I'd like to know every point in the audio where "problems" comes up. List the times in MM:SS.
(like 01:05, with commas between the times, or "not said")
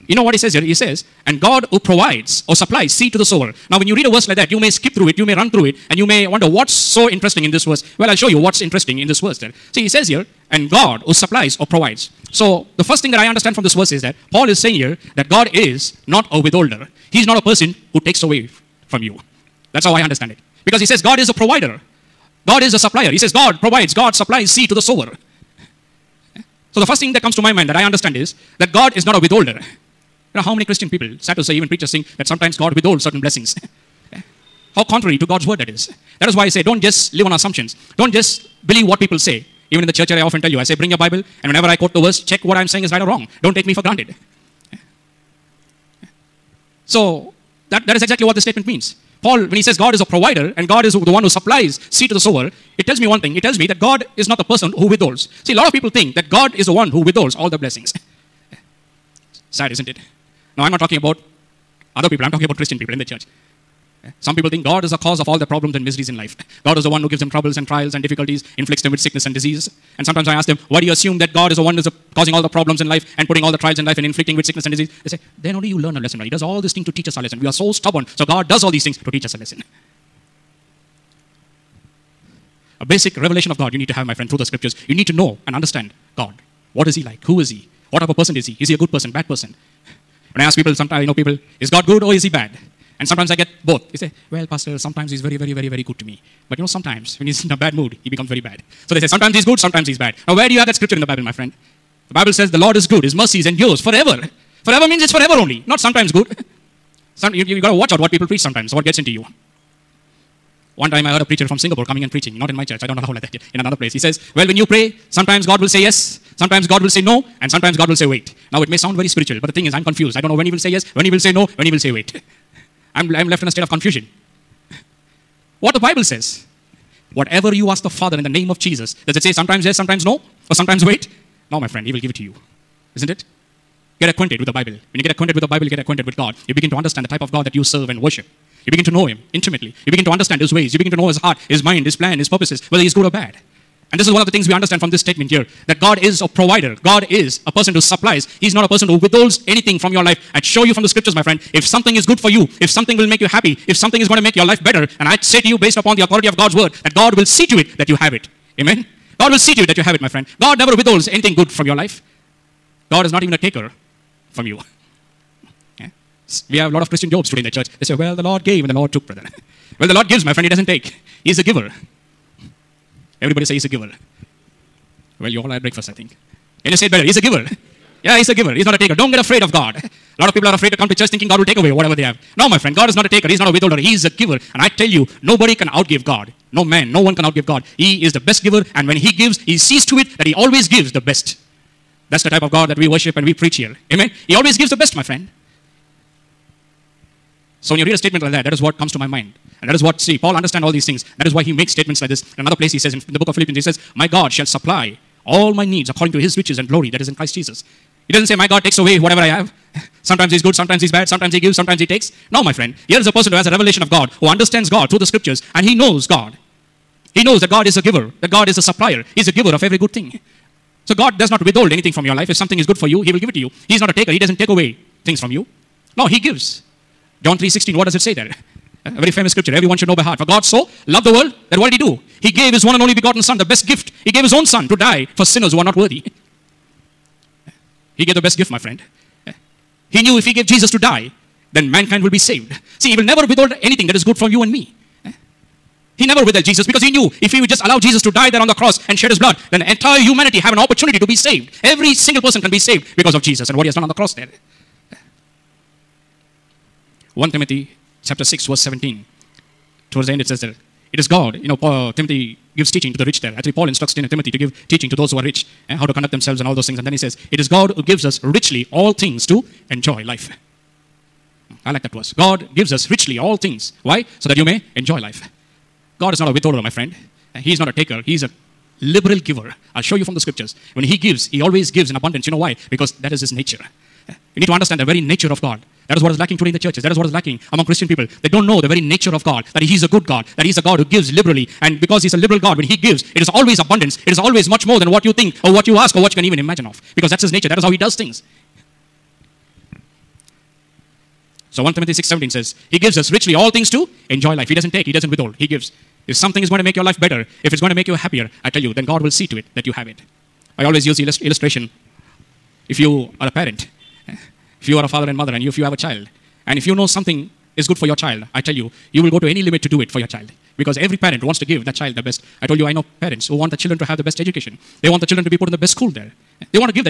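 01:05, 01:12.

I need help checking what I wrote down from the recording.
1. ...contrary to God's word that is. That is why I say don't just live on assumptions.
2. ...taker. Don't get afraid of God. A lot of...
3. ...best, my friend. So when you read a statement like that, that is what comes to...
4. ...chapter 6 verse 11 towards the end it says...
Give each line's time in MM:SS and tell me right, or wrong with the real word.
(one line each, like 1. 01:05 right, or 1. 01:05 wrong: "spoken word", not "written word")
1. 00:34 right
2. 02:58 right
3. 03:14 right
4. 04:18 wrong: "17", not "11".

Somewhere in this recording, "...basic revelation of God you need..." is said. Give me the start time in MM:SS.
01:22.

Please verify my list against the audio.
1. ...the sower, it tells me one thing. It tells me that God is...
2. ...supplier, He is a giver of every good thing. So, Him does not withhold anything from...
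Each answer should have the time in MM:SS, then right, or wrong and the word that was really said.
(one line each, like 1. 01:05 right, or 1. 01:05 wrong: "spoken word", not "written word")
1. 00:52 right
2. 03:38 wrong: "God", not "Him".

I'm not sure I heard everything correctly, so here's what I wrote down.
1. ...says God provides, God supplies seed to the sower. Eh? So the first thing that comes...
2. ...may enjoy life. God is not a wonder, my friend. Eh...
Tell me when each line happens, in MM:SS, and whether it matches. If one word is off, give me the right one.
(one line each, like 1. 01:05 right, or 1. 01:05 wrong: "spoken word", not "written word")
1. 00:23 right
2. 04:34 wrong: "withholder", not "wonder".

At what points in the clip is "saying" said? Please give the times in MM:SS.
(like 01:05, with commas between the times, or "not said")
00:14, 00:42.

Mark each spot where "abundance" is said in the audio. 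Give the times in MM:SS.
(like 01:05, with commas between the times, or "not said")
04:41, 04:53.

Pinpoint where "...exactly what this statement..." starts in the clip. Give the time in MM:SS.
00:48.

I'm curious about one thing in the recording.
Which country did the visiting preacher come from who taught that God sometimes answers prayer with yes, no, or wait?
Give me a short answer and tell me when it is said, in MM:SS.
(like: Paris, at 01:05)
Singapore, at 01:51.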